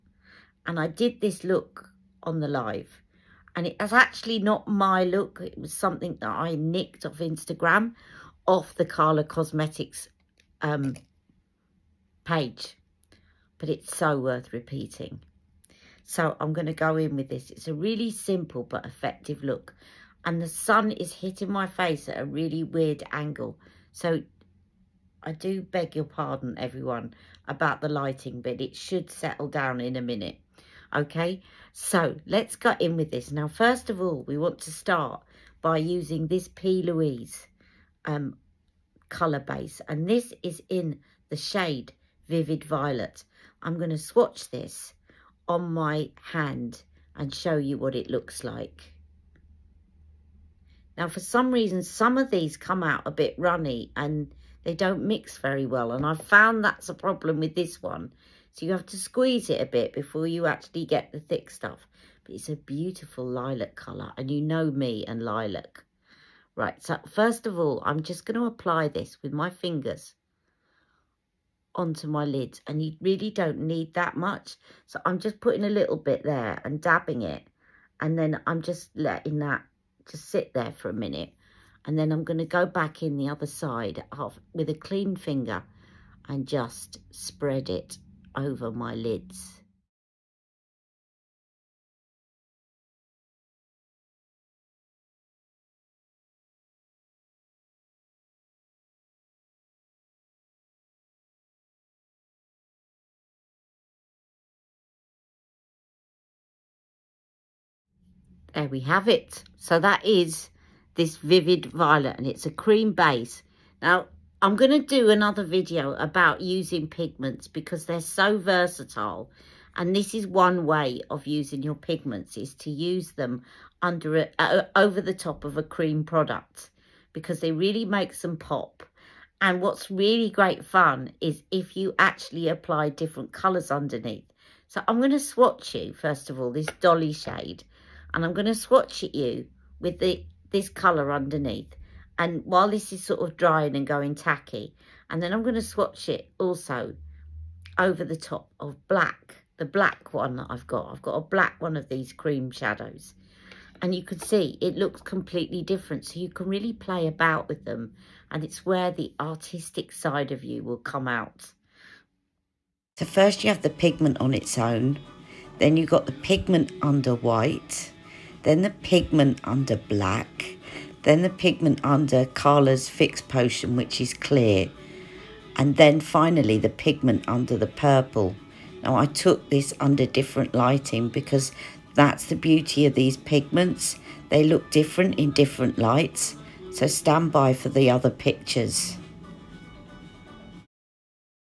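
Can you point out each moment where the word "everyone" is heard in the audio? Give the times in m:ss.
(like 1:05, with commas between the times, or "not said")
0:26.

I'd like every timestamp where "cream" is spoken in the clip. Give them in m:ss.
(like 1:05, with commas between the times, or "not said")
1:52, 2:05, 2:32.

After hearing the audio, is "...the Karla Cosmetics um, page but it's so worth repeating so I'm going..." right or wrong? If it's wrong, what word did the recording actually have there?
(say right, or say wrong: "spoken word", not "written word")
right.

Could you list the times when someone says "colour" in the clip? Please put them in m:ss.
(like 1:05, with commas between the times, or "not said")
0:39, 1:03, 2:13, 2:20.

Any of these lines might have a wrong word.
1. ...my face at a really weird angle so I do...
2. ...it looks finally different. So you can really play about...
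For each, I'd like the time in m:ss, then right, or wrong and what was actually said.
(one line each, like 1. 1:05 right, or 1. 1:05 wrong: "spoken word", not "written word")
1. 0:21 right
2. 2:34 wrong: "completely", not "finally".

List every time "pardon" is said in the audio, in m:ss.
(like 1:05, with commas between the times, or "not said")
0:26.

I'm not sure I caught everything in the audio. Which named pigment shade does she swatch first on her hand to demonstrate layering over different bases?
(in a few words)
Dolly.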